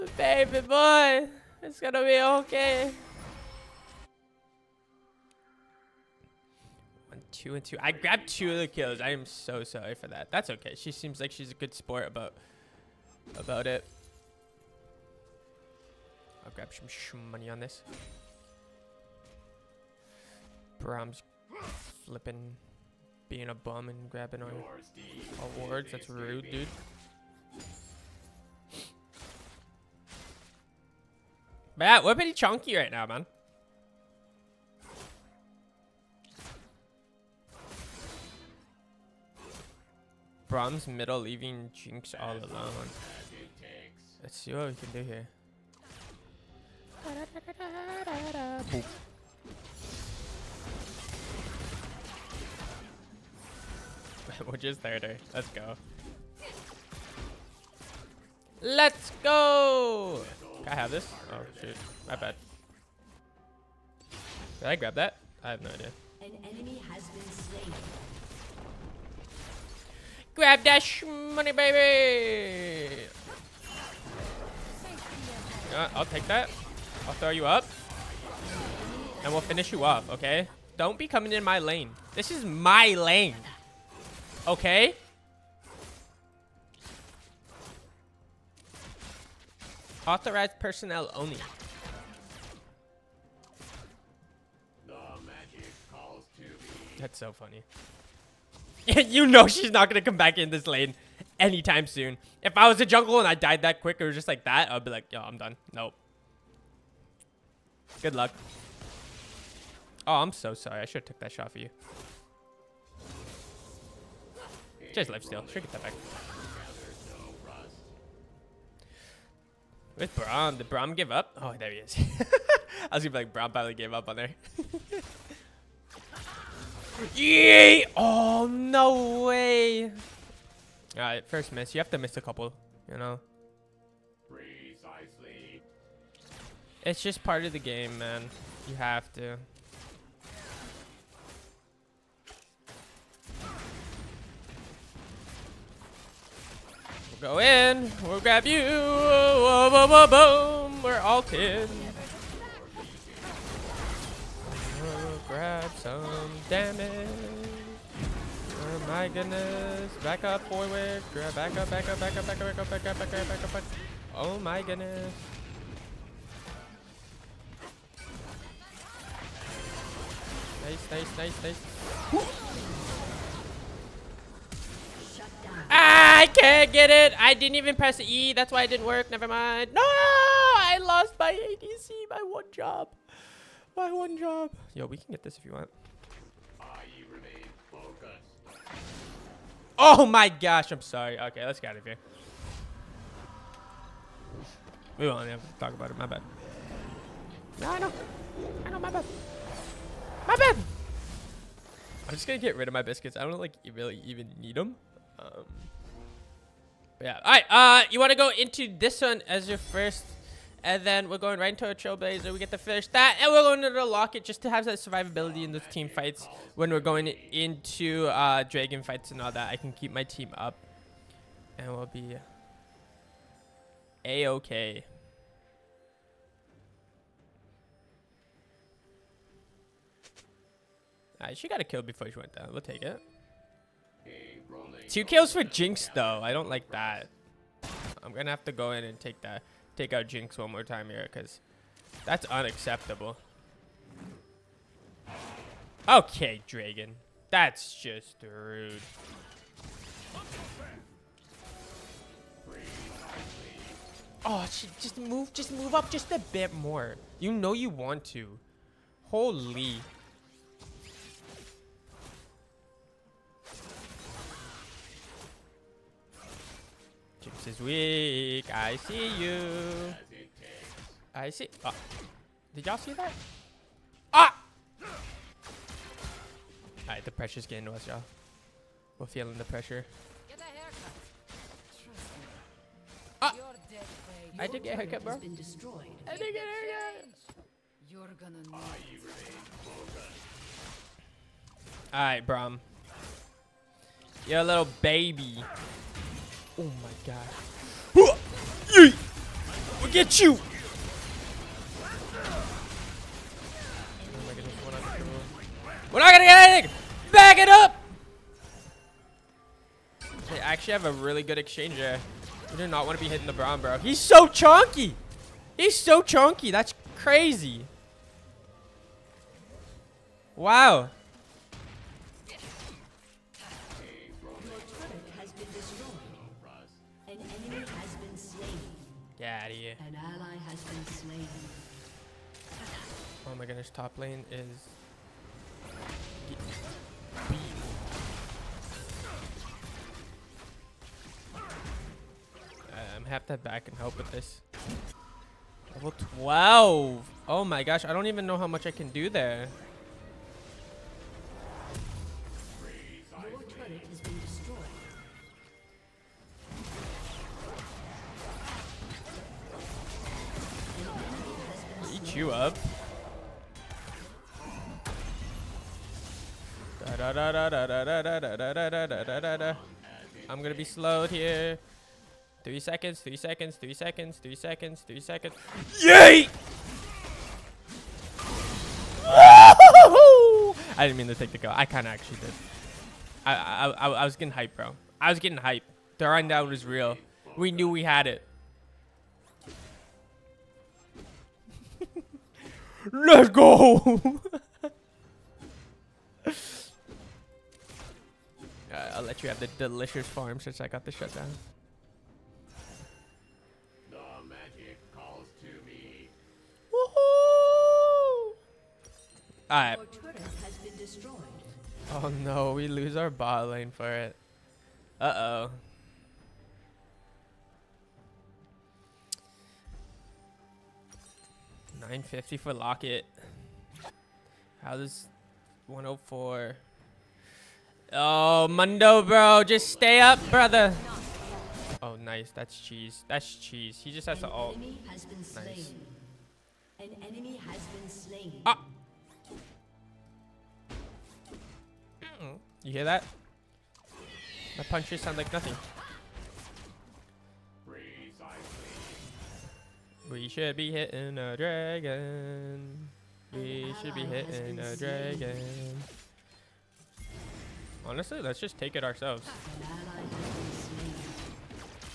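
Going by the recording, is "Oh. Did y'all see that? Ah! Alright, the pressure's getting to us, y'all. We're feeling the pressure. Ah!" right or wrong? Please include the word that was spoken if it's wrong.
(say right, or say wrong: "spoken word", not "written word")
right.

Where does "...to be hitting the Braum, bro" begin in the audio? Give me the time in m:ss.
5:12.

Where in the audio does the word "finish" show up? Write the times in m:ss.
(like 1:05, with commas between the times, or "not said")
1:19, 3:32.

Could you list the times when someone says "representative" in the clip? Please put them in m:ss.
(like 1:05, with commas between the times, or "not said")
not said.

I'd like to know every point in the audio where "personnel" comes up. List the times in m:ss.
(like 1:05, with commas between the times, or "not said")
1:30.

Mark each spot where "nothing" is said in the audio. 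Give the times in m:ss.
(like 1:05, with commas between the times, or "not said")
7:25.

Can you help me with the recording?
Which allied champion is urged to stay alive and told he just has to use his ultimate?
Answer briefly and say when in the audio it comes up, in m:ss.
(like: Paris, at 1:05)
Mundo, at 7:08.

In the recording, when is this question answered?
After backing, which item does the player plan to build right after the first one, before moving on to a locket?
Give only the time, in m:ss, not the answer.
3:31.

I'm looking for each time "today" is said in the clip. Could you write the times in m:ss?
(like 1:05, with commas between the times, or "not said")
not said.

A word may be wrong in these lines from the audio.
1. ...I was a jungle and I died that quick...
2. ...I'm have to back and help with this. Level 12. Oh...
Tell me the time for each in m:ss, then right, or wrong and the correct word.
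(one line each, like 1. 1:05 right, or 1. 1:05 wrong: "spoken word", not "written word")
1. 1:42 right
2. 5:42 right.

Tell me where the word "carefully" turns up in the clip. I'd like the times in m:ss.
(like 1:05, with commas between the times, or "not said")
not said.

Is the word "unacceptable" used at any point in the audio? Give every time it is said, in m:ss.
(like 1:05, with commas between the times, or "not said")
4:02.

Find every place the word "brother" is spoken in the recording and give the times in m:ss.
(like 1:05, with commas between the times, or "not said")
7:10.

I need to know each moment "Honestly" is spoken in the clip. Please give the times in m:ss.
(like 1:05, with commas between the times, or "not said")
7:37.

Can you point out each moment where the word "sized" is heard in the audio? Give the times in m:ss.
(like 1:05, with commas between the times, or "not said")
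not said.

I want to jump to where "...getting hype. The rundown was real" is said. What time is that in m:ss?
6:25.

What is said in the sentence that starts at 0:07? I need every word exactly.
I grabbed two of the kills.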